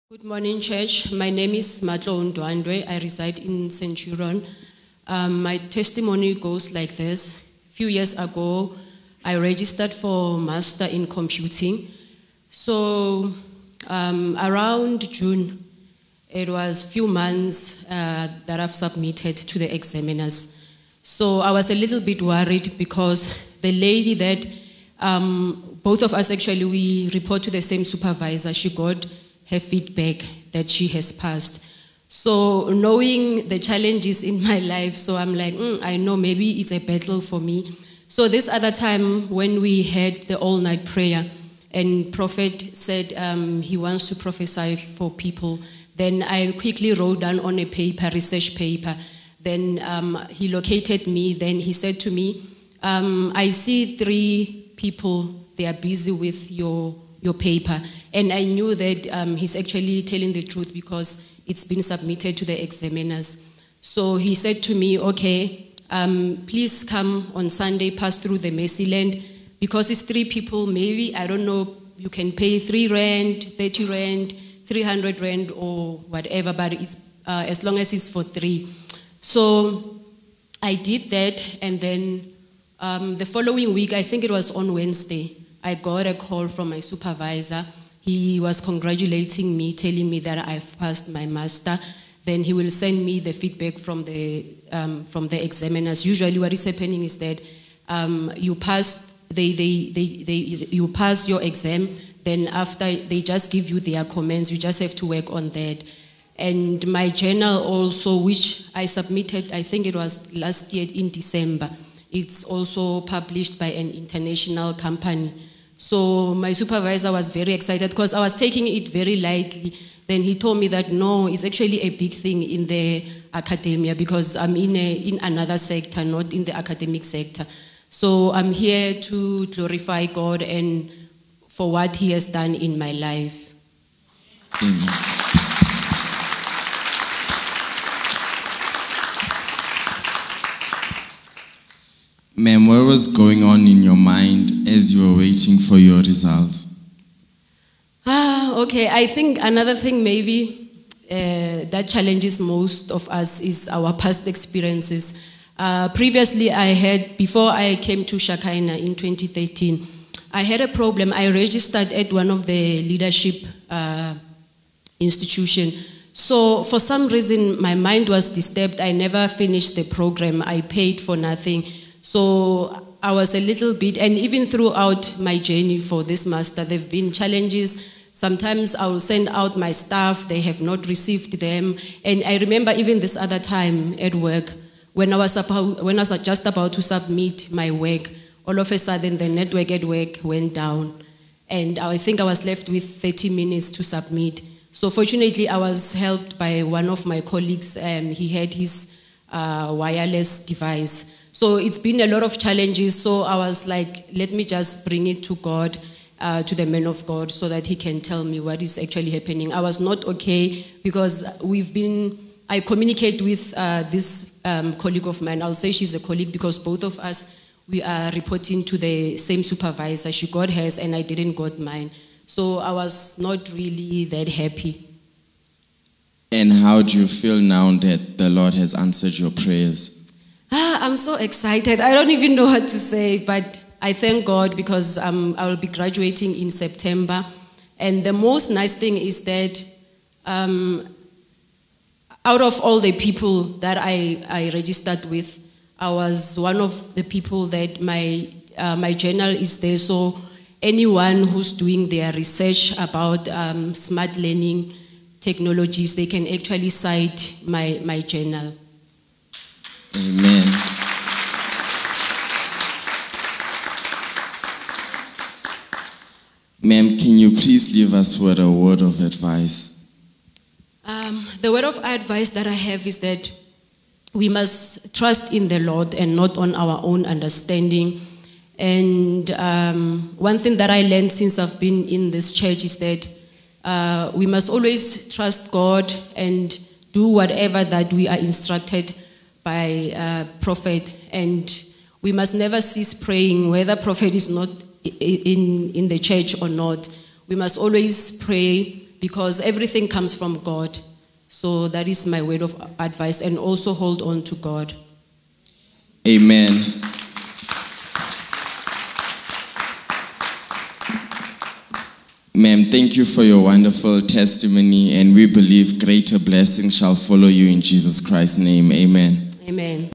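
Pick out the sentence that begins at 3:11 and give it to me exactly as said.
And I think I was left with 30 minutes to submit.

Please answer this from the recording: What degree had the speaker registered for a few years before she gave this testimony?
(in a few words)
Master in Computing.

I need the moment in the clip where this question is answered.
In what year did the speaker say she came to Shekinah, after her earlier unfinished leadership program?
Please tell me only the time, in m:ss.
2:38.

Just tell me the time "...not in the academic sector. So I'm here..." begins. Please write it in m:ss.
2:06.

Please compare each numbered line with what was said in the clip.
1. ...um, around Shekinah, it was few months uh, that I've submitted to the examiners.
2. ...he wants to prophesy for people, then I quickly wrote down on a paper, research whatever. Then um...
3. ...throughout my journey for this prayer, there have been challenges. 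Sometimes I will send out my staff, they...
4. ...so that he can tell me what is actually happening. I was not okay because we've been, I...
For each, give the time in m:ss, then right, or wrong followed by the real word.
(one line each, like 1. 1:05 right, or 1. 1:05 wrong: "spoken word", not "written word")
1. 0:13 wrong: "June", not "Shekinah"
2. 0:43 wrong: "paper", not "whatever"
3. 2:54 wrong: "master", not "prayer"
4. 3:27 right.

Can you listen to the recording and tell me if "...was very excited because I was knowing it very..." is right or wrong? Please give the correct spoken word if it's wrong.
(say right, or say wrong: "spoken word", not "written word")
wrong: "taking", not "knowing".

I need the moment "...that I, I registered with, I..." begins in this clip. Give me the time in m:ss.
4:03.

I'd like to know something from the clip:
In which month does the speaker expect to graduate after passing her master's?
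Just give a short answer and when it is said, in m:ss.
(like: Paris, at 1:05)
September, at 3:56.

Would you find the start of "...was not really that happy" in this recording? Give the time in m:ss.
3:42.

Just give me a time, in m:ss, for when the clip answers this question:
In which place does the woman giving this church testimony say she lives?
0:03.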